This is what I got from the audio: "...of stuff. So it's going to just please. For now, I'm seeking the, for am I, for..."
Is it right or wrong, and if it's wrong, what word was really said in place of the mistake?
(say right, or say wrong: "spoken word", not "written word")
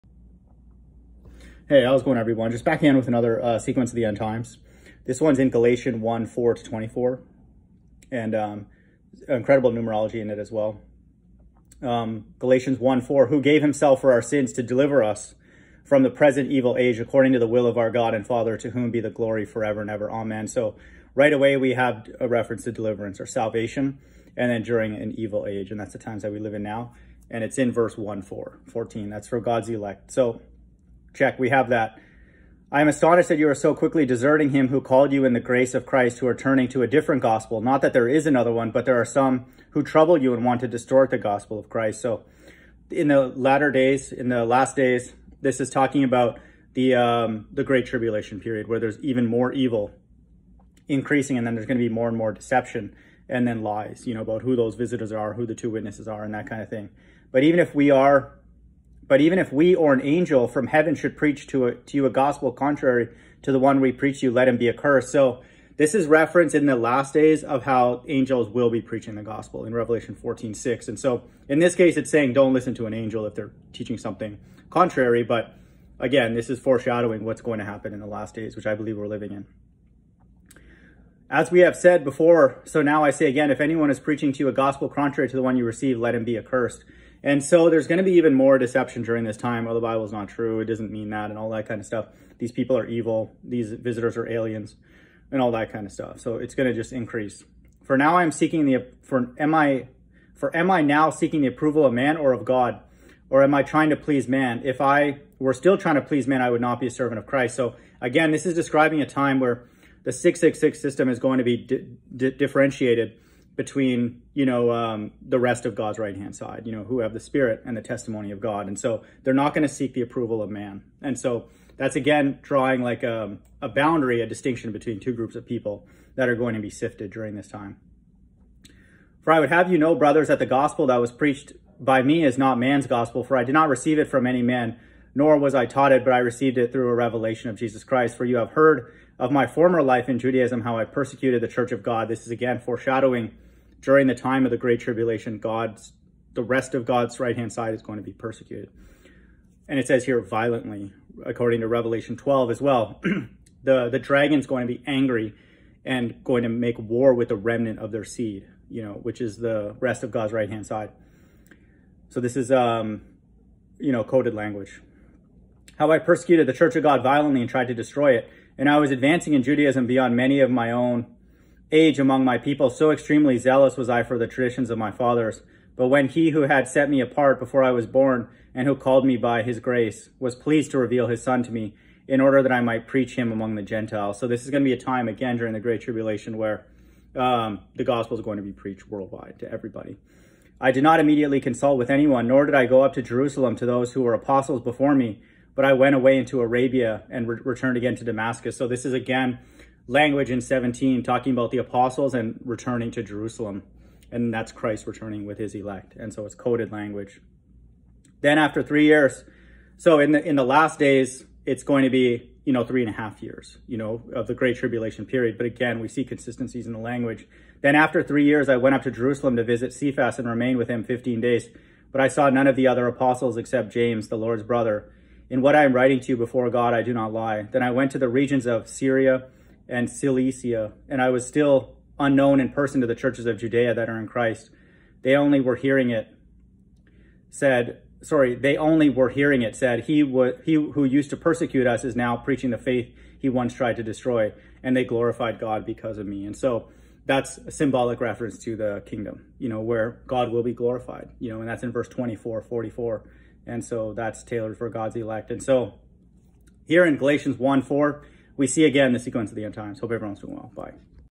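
wrong: "increase", not "please".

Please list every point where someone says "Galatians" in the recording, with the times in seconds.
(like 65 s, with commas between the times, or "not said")
5 s, 12 s, 256 s.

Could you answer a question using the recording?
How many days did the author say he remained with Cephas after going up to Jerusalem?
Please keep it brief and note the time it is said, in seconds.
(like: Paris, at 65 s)
15, at 220 s.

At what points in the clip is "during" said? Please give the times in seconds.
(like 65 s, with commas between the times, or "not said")
24 s, 89 s, 127 s, 143 s, 185 s.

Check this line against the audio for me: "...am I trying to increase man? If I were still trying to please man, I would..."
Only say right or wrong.
wrong.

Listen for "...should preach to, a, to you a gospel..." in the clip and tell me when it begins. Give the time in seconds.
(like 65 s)
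60 s.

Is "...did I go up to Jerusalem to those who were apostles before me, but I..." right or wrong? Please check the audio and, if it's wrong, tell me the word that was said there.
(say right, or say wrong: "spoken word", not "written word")
right.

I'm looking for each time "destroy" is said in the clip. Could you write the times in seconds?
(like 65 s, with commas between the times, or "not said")
167 s, 243 s.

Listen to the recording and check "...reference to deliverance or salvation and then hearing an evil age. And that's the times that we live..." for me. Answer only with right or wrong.
wrong.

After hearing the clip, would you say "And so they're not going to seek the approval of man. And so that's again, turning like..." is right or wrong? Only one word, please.
wrong.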